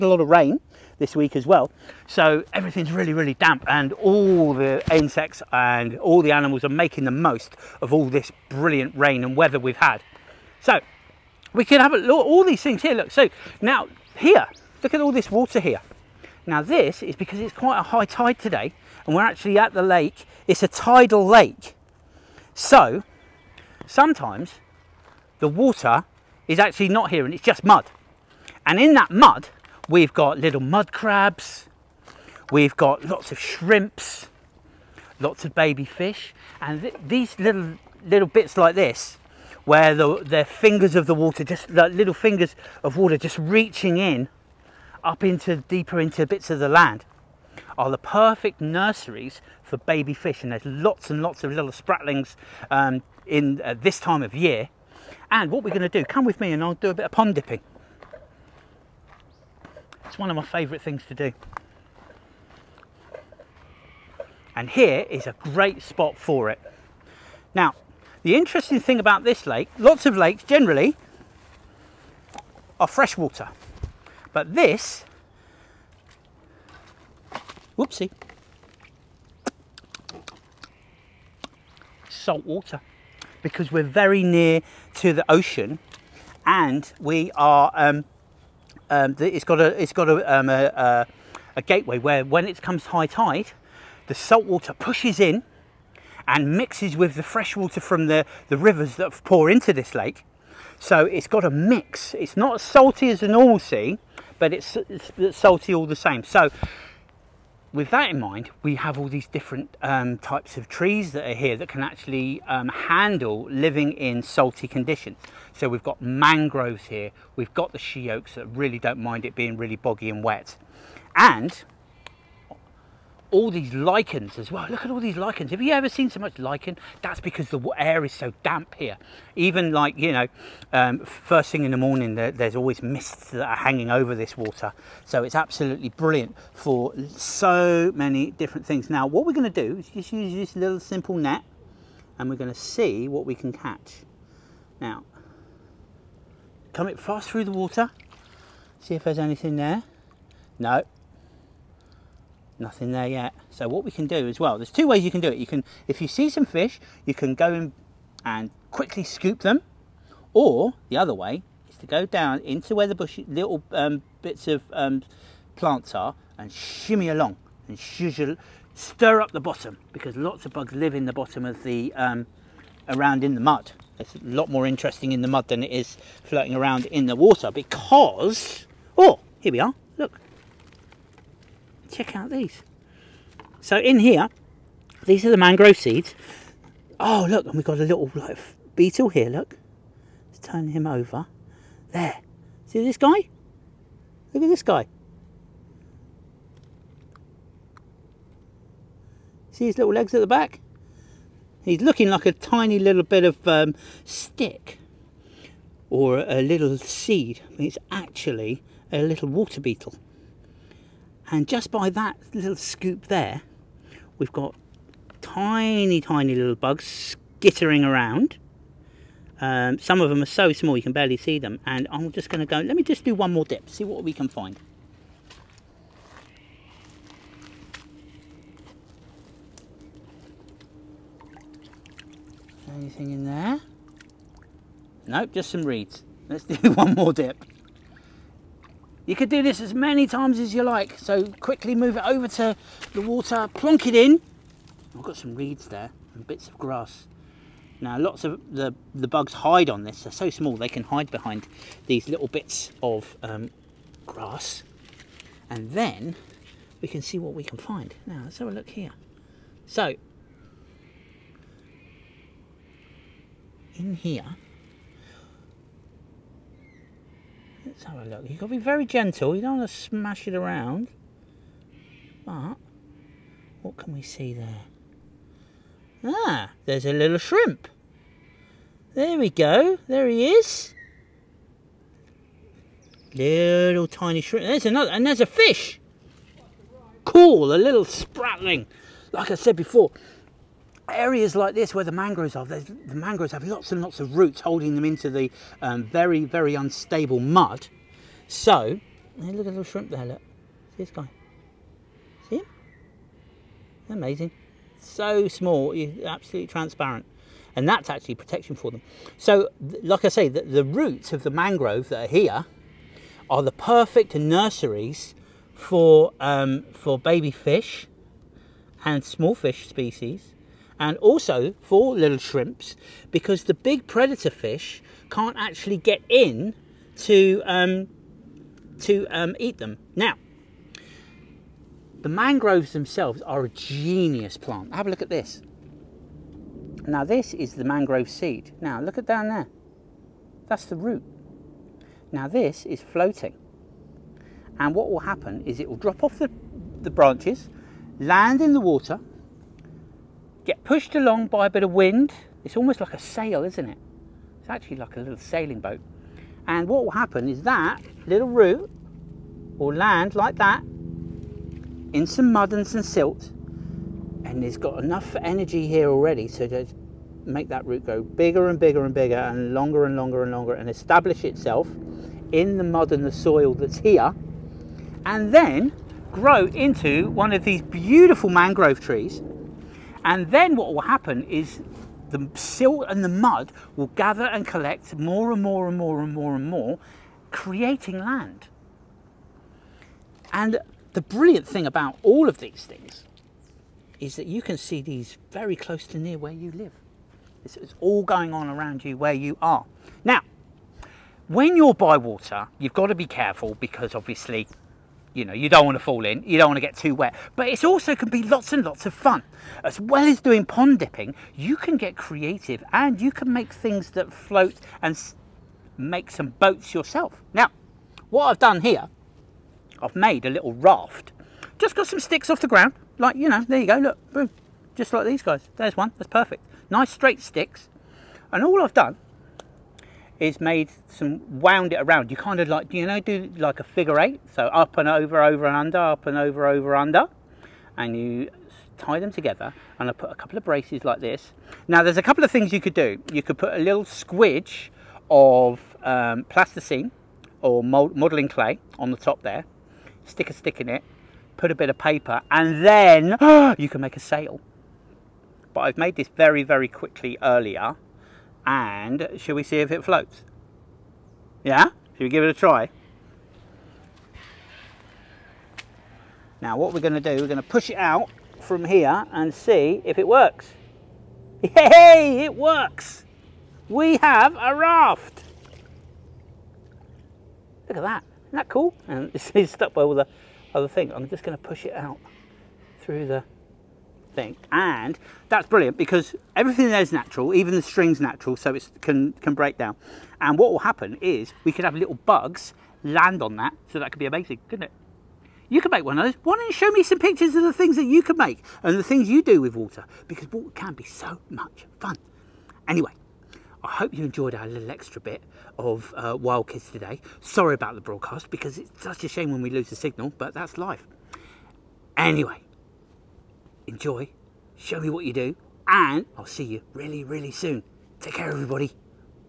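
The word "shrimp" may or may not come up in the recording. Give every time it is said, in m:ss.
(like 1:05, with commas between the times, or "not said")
0:33, 4:37, 4:44, 4:59, 5:22.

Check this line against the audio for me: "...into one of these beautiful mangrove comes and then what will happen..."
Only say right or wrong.
wrong.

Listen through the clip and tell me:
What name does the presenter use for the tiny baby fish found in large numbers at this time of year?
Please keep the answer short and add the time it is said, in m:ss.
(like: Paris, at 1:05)
Spratlings, at 0:51.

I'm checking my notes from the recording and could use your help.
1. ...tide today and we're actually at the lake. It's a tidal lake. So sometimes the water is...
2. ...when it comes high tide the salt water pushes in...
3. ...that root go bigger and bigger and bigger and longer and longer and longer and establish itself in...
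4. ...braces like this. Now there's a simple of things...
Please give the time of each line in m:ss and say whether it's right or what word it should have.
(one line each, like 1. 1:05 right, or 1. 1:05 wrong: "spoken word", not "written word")
1. 0:18 right
2. 1:32 right
3. 6:07 right
4. 7:20 wrong: "couple", not "simple".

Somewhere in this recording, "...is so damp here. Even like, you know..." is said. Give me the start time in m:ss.
2:08.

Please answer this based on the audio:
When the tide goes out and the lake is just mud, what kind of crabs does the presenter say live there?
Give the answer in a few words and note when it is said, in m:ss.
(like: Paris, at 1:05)
Mud crabs, at 0:30.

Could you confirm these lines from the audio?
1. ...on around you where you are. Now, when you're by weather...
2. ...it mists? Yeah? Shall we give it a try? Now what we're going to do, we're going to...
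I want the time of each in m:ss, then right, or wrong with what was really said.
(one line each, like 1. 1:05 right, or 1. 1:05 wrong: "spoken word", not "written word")
1. 6:38 wrong: "water", not "weather"
2. 7:39 wrong: "floats", not "mists".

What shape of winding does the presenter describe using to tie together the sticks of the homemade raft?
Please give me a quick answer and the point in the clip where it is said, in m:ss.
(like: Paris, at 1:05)
Figure eight, at 7:13.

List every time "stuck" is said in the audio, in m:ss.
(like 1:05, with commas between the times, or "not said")
7:59.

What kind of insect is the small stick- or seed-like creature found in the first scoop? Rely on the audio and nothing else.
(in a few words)
Water beetle.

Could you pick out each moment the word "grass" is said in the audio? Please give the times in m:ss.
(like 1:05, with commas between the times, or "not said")
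4:06, 4:14.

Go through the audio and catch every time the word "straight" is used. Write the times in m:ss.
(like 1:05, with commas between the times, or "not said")
7:06.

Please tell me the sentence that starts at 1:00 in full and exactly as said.
It's one of my favourite things to do.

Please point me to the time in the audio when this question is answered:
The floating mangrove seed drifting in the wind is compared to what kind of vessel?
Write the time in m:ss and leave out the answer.
5:55.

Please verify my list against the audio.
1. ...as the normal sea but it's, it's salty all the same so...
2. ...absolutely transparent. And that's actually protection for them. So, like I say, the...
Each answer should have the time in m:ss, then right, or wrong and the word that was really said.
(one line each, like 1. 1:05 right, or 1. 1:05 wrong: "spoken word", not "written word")
1. 1:43 right
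2. 5:06 right.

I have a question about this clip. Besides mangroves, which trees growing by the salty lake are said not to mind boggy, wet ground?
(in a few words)
She oaks.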